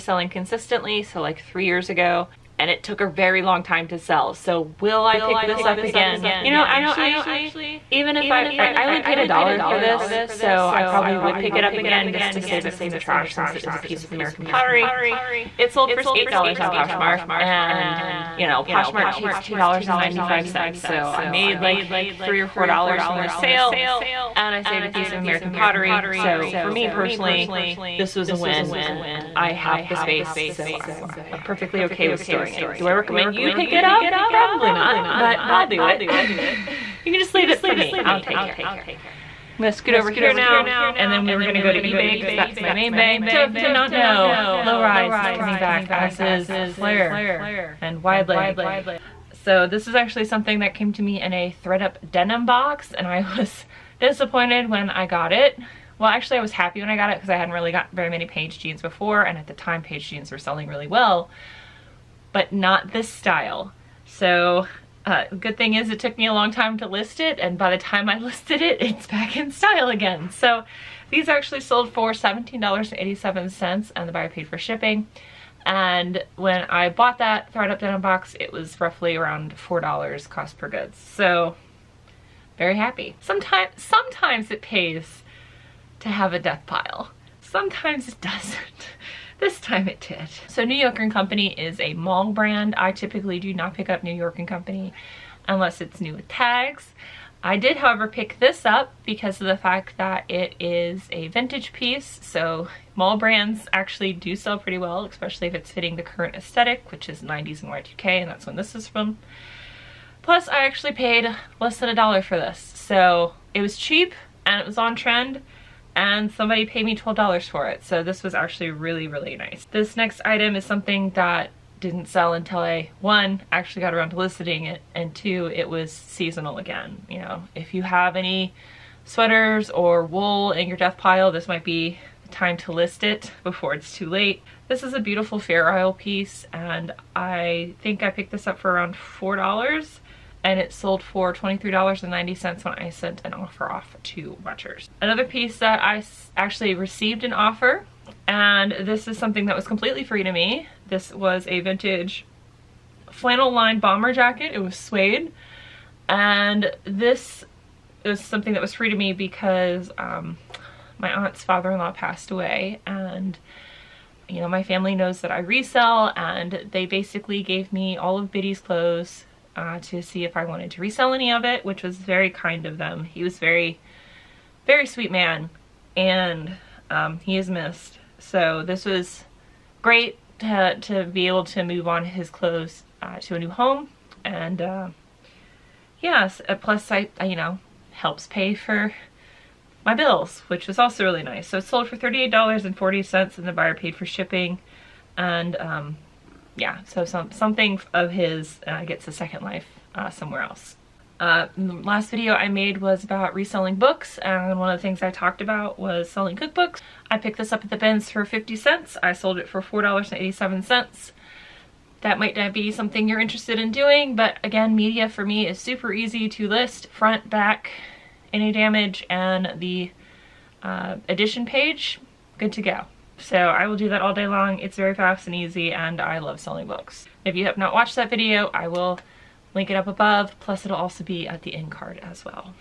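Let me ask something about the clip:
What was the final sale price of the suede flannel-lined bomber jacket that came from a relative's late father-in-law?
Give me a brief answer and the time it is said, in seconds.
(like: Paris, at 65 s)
$38.40, at 191 s.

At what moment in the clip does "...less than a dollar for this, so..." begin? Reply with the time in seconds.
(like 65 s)
111 s.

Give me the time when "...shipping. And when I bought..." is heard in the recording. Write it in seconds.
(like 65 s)
74 s.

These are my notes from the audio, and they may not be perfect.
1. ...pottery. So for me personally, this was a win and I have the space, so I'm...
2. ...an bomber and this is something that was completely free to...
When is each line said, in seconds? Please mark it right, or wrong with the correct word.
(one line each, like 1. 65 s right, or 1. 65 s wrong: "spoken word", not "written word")
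1. 25 s right
2. 147 s wrong: "offer", not "bomber".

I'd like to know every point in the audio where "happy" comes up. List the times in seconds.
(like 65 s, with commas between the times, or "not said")
56 s, 82 s.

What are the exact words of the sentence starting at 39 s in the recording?
I'm gonna scoot over here now and then we were gonna go to eBay because that's my main bay.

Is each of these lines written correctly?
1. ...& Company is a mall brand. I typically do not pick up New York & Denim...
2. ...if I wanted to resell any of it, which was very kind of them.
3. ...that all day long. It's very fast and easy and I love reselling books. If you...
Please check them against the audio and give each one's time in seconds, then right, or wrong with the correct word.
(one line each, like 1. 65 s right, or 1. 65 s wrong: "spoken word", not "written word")
1. 91 s wrong: "Company", not "Denim"
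2. 170 s right
3. 223 s wrong: "selling", not "reselling".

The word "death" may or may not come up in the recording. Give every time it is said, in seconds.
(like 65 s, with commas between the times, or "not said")
86 s, 130 s.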